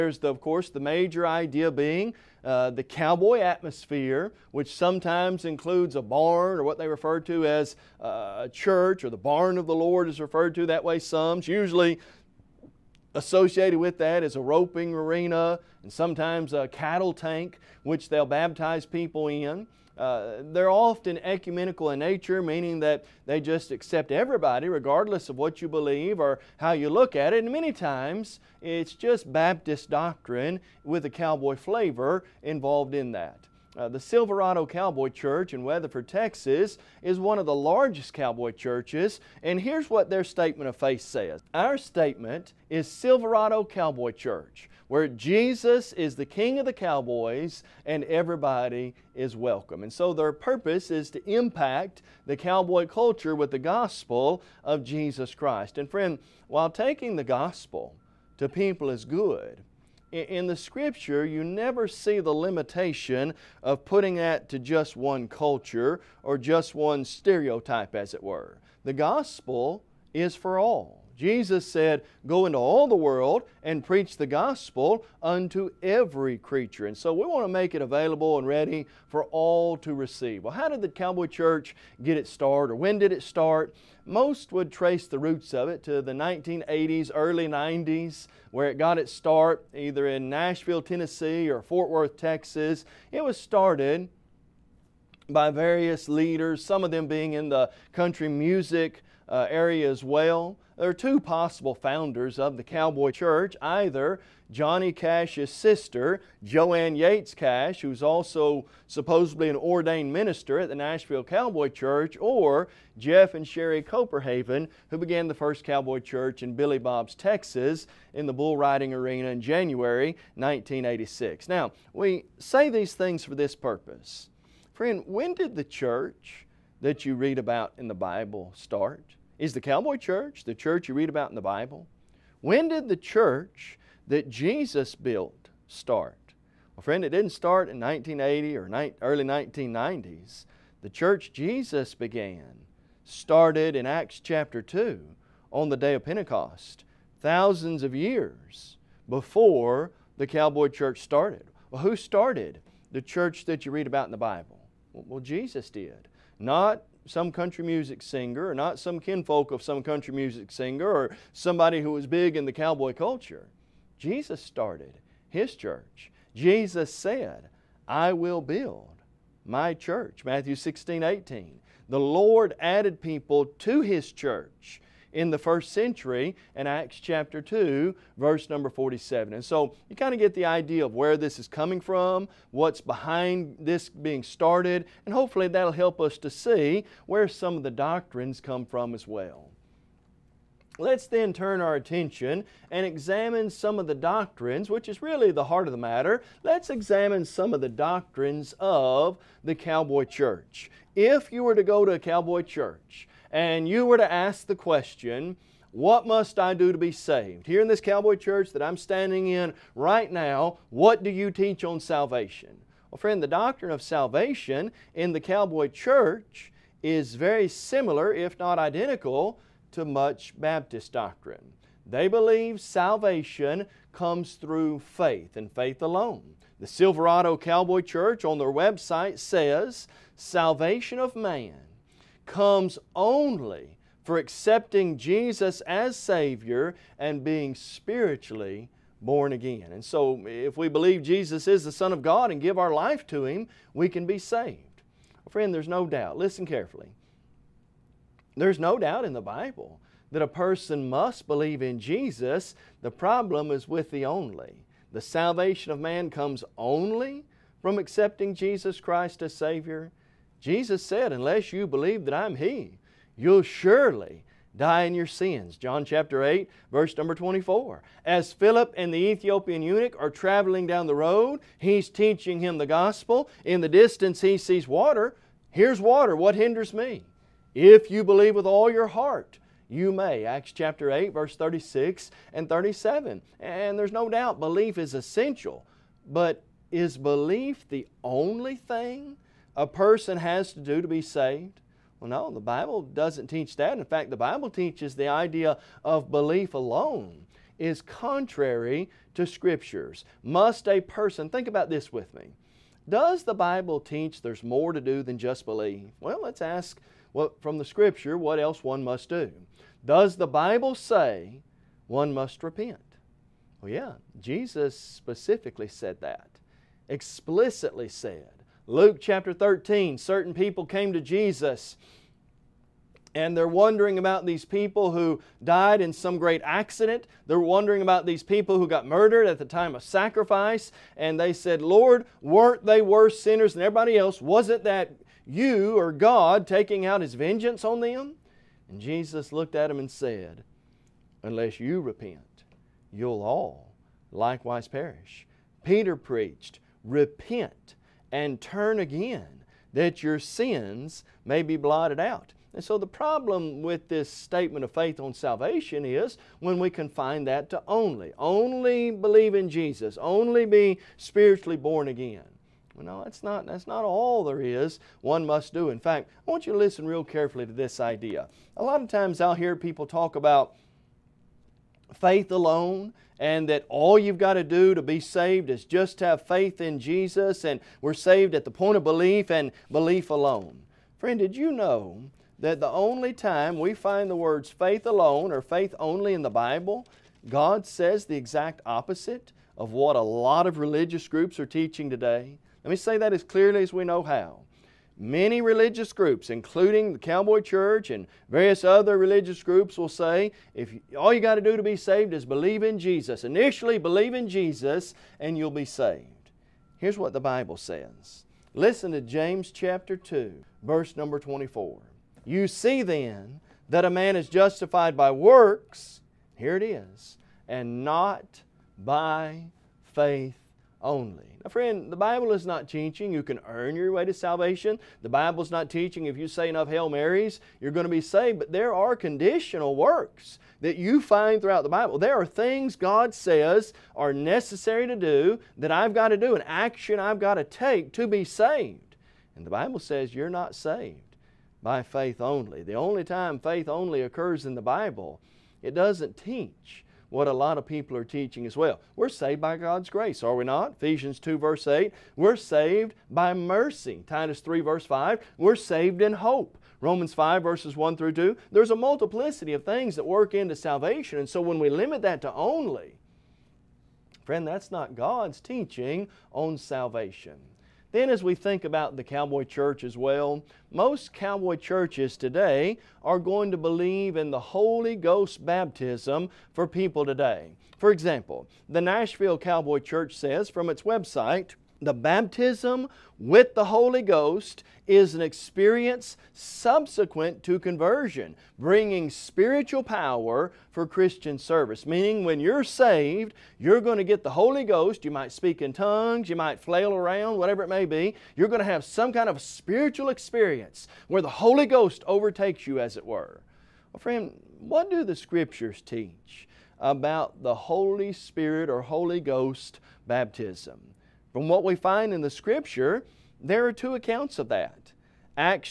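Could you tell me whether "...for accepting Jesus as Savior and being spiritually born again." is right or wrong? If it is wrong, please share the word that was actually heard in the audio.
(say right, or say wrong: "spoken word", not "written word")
right.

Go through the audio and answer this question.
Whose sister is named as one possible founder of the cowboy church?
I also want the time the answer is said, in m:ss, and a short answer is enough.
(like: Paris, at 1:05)
Johnny Cash, at 1:44.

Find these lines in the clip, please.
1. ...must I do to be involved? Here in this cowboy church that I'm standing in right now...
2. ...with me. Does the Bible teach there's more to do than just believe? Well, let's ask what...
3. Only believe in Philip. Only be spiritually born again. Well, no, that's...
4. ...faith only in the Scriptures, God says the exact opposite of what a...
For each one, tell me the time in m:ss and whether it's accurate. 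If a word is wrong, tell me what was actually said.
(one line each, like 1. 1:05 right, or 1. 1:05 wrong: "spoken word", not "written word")
1. 3:26 wrong: "saved", not "involved"
2. 5:01 right
3. 5:58 wrong: "Jesus", not "Philip"
4. 6:25 wrong: "Bible", not "Scriptures".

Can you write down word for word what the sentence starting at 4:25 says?
John chapter 8, verse number 24.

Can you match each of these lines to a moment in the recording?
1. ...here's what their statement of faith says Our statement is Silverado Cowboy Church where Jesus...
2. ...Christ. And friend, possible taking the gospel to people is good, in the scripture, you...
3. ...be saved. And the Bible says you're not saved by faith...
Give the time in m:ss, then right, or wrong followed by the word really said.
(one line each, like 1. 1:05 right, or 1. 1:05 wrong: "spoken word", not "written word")
1. 0:39 right
2. 0:55 wrong: "while", not "possible"
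3. 7:18 right.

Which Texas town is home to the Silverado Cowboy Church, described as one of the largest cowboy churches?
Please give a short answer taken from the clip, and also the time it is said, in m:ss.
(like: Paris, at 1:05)
Weatherford, at 0:35.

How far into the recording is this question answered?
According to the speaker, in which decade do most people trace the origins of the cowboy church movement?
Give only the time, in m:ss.
1:26.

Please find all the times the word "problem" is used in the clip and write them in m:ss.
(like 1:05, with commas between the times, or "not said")
4:12, 5:52.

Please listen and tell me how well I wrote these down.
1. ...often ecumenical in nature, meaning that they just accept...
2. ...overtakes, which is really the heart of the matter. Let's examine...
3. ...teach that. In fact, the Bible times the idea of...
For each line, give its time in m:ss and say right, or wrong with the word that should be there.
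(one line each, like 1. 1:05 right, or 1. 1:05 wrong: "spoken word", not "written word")
1. 0:20 right
2. 3:13 wrong: "doctrines", not "overtakes"
3. 4:53 wrong: "teaches", not "times".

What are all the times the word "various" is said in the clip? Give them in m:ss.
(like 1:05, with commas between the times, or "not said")
1:35, 6:38.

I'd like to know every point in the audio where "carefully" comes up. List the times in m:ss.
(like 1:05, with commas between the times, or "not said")
4:06, 6:07.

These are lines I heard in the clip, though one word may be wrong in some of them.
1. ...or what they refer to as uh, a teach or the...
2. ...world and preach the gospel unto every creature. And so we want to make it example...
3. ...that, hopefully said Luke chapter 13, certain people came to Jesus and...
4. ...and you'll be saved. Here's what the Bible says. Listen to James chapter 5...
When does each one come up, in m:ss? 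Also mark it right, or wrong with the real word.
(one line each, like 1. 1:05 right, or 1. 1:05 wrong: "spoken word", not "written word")
1. 0:06 wrong: "church", not "teach"
2. 1:12 wrong: "available", not "example"
3. 5:16 wrong: "explicitly", not "hopefully"
4. 6:45 wrong: "2", not "5".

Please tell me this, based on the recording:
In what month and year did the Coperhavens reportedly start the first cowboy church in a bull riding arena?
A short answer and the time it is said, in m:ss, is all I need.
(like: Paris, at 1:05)
January 1986, at 1:59.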